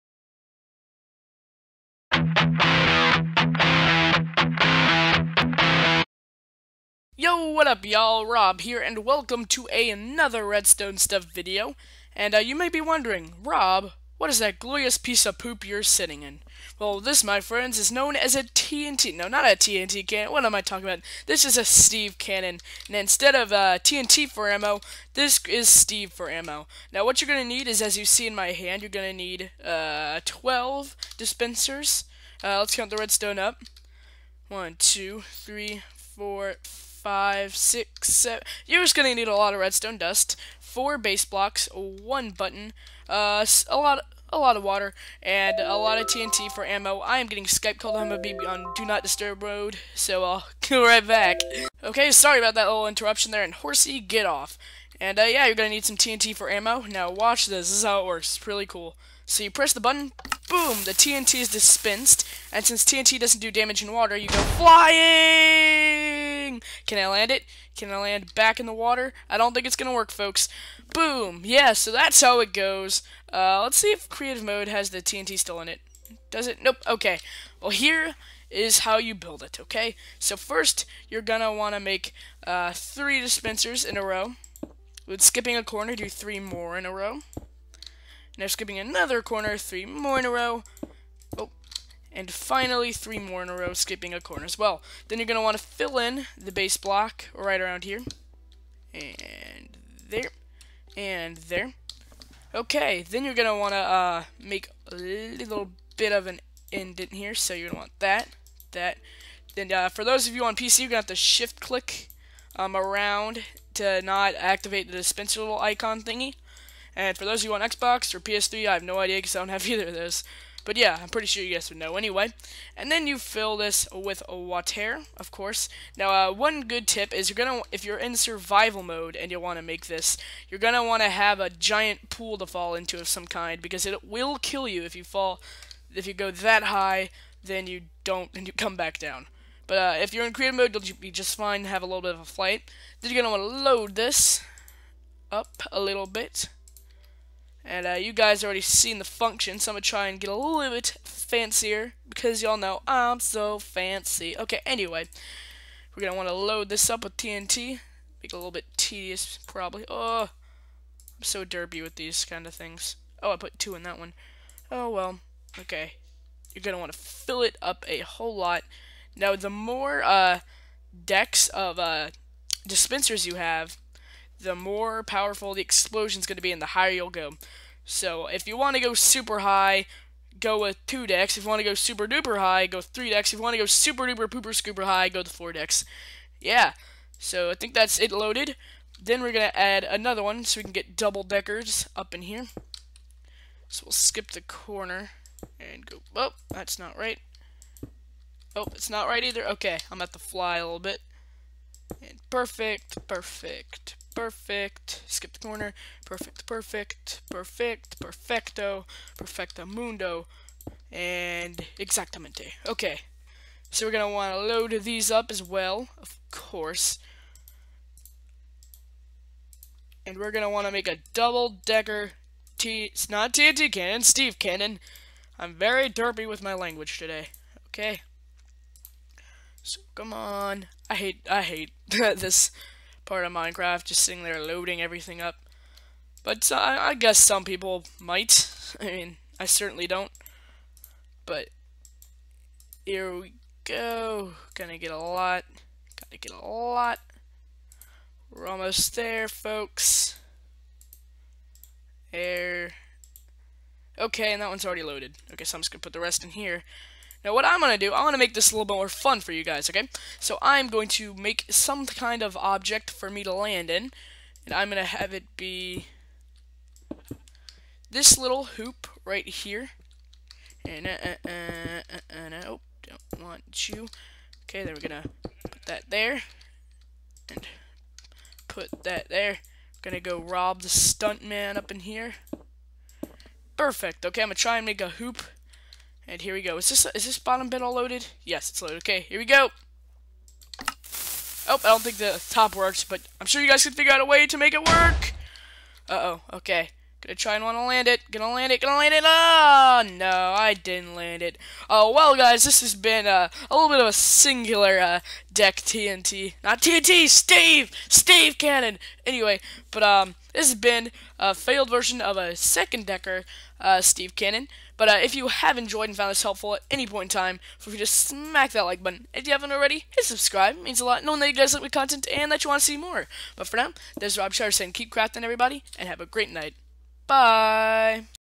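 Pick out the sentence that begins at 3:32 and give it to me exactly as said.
Okay, so we're going to want to load these up as well, of course.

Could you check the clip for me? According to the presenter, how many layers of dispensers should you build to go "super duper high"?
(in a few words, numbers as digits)
3.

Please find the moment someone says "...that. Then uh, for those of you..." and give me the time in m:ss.
1:48.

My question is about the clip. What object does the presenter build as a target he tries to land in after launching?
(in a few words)
a hoop.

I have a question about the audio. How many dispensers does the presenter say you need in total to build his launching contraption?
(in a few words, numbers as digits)
12.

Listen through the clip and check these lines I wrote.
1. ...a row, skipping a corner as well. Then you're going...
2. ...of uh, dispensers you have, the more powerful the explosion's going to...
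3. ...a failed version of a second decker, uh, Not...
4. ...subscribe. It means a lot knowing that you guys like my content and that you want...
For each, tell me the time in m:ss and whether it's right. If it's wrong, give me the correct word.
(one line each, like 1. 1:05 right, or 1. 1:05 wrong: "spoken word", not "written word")
1. 1:33 right
2. 2:51 right
3. 5:11 wrong: "Steve", not "Not"
4. 5:20 right.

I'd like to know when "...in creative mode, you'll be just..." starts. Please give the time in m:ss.
2:20.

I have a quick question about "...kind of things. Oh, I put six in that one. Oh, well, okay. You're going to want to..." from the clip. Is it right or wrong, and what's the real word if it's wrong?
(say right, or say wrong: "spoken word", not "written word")
wrong: "two", not "six".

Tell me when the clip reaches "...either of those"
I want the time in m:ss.
1:59.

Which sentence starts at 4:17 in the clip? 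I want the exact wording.
Now what I'm going to do, I want to make this a little bit more fun for you guys, okay?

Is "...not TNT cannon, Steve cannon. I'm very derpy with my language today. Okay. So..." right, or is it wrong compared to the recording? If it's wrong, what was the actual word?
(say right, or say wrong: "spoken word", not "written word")
right.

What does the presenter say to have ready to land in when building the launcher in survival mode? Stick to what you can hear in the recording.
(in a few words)
a giant pool.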